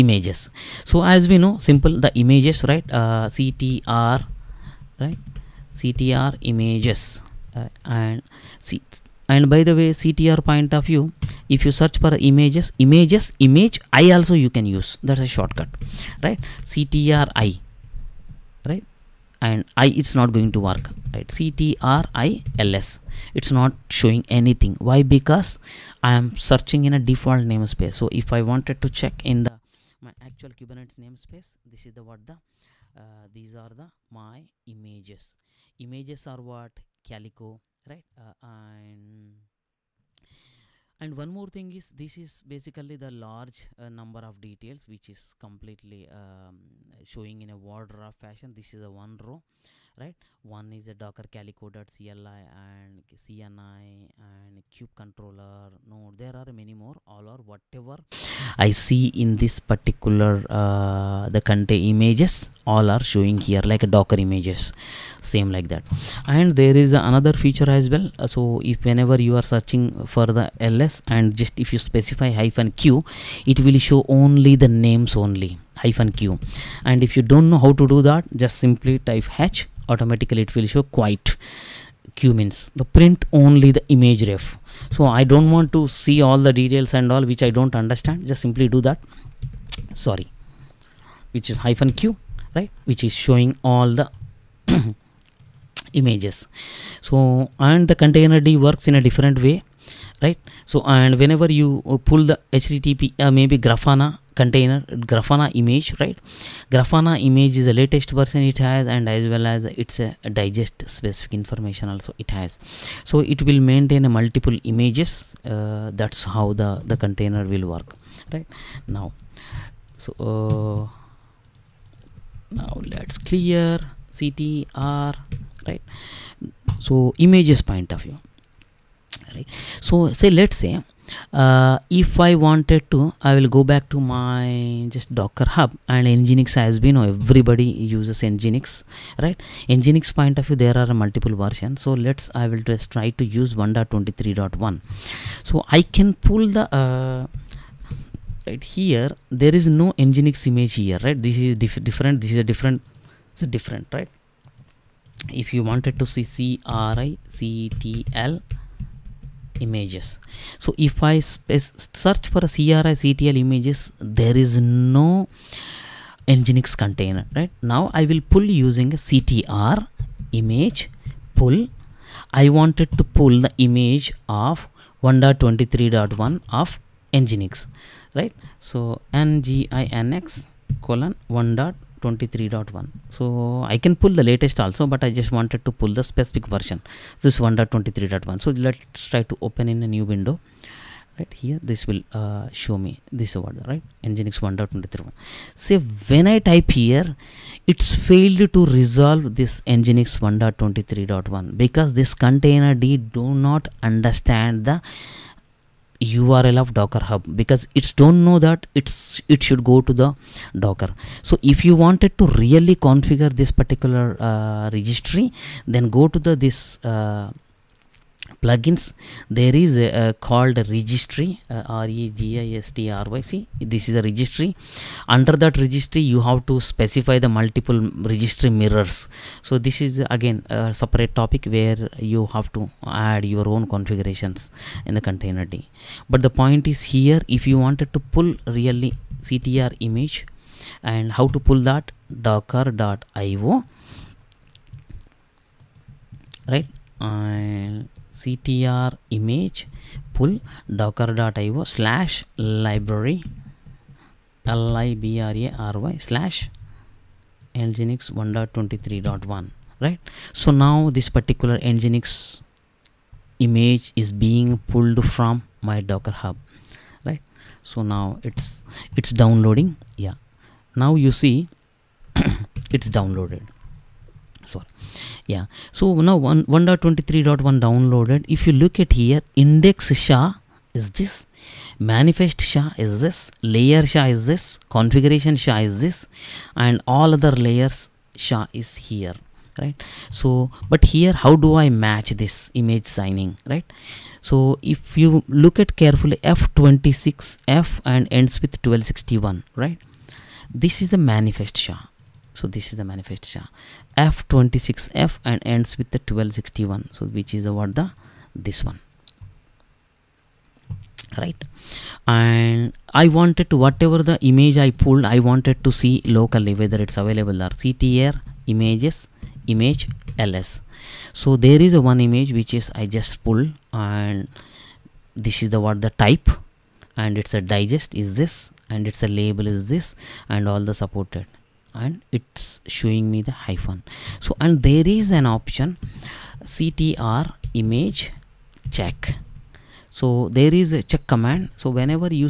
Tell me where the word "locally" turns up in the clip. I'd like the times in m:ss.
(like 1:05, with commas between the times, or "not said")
5:16.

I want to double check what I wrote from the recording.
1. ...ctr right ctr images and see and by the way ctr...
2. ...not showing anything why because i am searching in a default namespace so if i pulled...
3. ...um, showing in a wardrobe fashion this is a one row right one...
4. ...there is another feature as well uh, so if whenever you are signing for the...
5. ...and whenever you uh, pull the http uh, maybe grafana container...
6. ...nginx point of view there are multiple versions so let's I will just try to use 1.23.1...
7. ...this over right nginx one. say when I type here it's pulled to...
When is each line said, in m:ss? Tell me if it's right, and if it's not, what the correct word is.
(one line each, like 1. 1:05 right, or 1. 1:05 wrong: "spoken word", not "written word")
1. 0:03 right
2. 0:23 wrong: "wanted", not "pulled"
3. 0:46 right
4. 1:06 wrong: "searching", not "signing"
5. 1:40 right
6. 2:19 right
7. 3:13 wrong: "failed", not "pulled".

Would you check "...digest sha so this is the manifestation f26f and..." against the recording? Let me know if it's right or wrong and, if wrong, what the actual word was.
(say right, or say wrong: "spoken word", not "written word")
wrong: "manifest", not "digest".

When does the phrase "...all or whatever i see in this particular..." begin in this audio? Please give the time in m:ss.
0:57.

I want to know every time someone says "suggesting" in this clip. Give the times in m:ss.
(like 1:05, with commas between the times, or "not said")
not said.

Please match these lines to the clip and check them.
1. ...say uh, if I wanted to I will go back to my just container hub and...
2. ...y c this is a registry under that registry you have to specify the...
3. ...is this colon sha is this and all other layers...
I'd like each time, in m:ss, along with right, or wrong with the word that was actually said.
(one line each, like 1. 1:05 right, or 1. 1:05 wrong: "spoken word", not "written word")
1. 2:10 wrong: "docker", not "container"
2. 3:43 right
3. 4:44 wrong: "configuration", not "colon".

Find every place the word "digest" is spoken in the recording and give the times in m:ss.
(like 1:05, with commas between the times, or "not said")
1:50, 5:27.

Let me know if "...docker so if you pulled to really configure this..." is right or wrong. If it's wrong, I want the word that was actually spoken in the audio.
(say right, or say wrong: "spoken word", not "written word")
wrong: "wanted", not "pulled".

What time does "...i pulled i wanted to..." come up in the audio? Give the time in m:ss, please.
5:14.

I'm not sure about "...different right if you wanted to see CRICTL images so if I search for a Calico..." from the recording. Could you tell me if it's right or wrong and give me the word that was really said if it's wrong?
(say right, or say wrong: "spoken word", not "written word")
wrong: "CRICTL", not "Calico".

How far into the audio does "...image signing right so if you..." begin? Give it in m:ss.
4:52.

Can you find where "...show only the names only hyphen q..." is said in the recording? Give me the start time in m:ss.
1:13.